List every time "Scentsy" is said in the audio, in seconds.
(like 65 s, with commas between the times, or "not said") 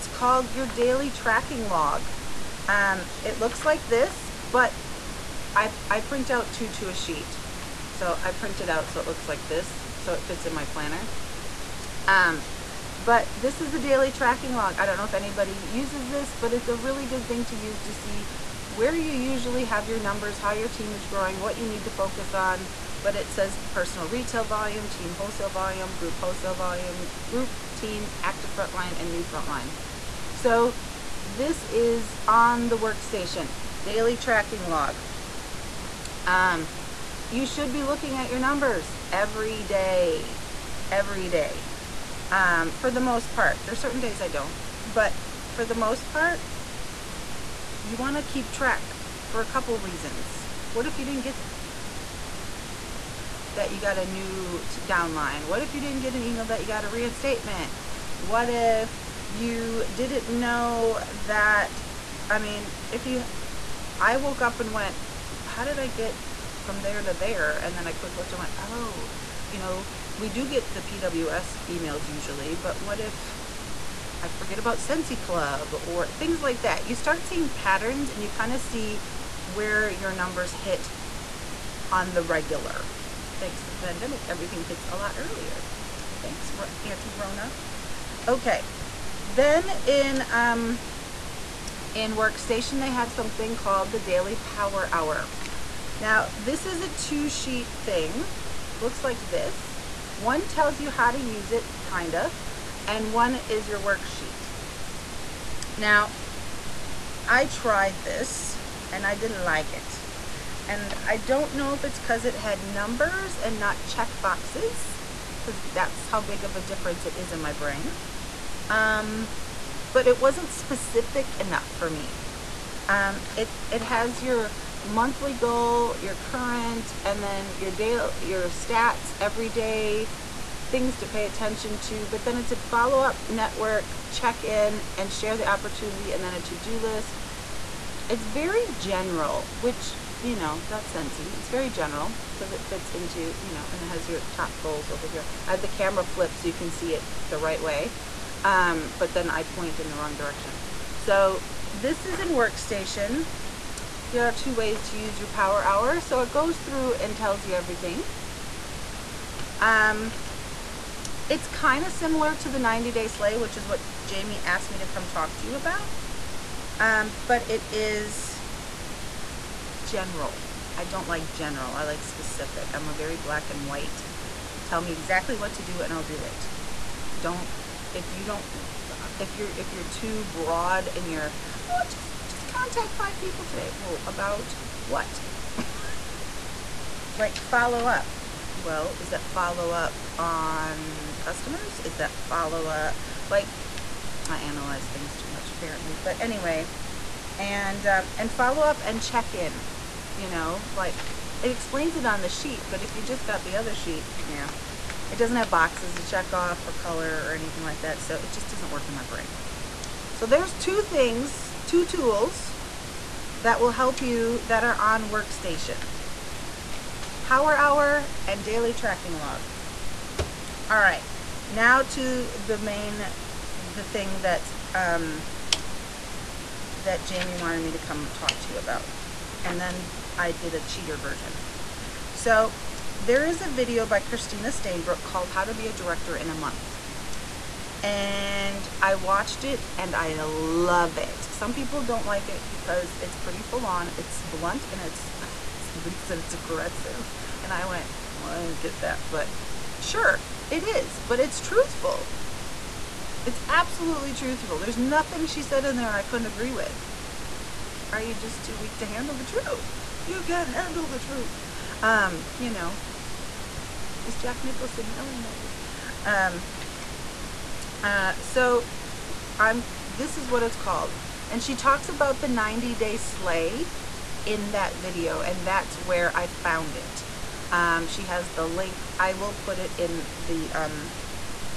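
74 s, 140 s.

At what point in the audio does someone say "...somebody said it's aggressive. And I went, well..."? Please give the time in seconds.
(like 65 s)
245 s.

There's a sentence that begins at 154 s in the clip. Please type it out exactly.
Here are two ways to use your power hour.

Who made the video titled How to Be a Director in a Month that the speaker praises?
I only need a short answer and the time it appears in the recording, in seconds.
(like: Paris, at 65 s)
Christina Stainbrook, at 233 s.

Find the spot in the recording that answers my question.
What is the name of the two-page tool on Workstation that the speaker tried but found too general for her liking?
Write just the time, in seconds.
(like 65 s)
93 s.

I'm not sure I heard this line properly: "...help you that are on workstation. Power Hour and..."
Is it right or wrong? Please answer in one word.
right.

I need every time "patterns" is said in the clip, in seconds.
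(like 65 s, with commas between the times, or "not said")
77 s.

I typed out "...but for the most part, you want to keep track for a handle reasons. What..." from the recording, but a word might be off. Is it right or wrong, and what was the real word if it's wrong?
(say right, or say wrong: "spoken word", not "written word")
wrong: "couple", not "handle".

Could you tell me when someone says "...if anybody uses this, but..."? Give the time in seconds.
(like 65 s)
15 s.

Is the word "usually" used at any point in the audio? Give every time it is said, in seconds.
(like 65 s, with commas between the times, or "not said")
19 s, 72 s.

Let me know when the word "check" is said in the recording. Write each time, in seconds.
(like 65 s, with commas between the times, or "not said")
113 s, 134 s, 199 s, 206 s.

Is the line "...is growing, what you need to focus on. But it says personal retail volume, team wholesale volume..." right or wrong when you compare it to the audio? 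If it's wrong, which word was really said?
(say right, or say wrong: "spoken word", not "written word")
right.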